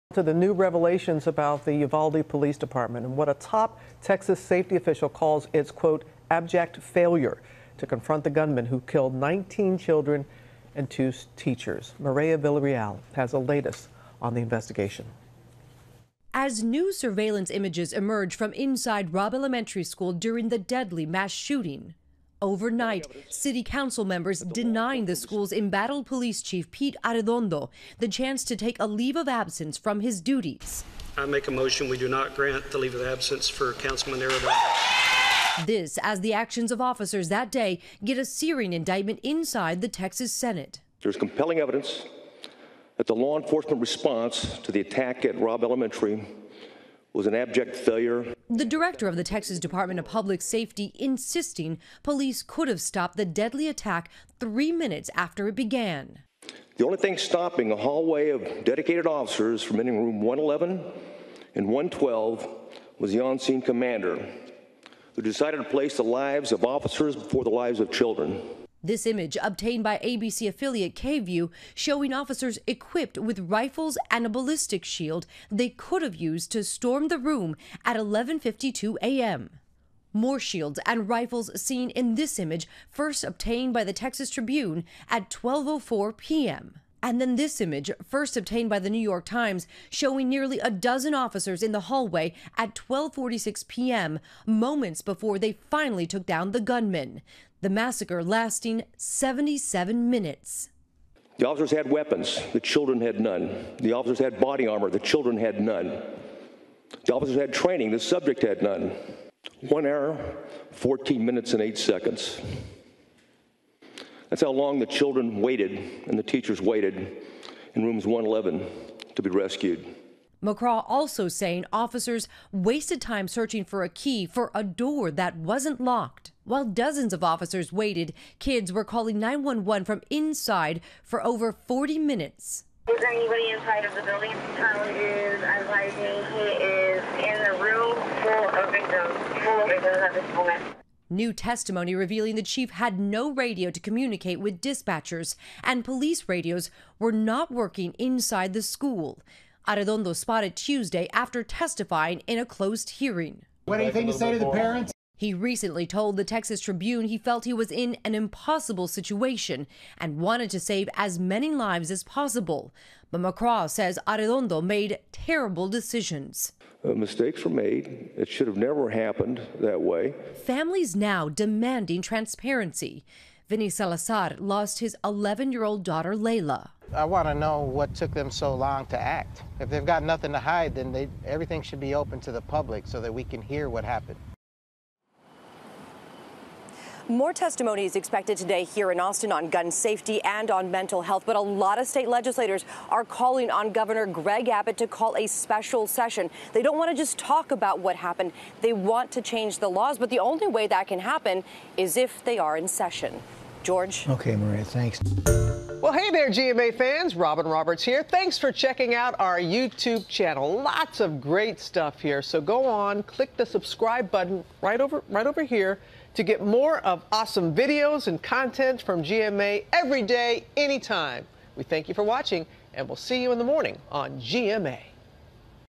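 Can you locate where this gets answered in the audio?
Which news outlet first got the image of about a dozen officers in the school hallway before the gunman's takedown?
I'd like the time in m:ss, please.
1:28.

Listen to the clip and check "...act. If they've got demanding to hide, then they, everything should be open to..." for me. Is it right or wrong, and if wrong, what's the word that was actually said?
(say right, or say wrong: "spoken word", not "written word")
wrong: "nothing", not "demanding".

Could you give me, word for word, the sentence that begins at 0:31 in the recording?
I make a motion we do not grant the leave of absence for Councilman Arredondo.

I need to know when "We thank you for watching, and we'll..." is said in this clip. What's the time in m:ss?
3:41.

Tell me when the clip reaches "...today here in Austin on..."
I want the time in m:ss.
3:08.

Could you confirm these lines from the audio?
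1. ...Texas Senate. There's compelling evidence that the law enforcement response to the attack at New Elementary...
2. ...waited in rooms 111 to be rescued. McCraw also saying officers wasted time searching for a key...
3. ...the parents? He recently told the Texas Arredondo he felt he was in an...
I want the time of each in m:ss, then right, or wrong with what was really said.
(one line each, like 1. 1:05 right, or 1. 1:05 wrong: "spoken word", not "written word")
1. 0:39 wrong: "Robb", not "New"
2. 1:56 right
3. 2:34 wrong: "Tribune", not "Arredondo".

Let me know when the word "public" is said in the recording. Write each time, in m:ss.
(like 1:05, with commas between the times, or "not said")
0:50, 3:02.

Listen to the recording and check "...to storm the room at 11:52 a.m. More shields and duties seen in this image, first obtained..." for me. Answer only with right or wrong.
wrong.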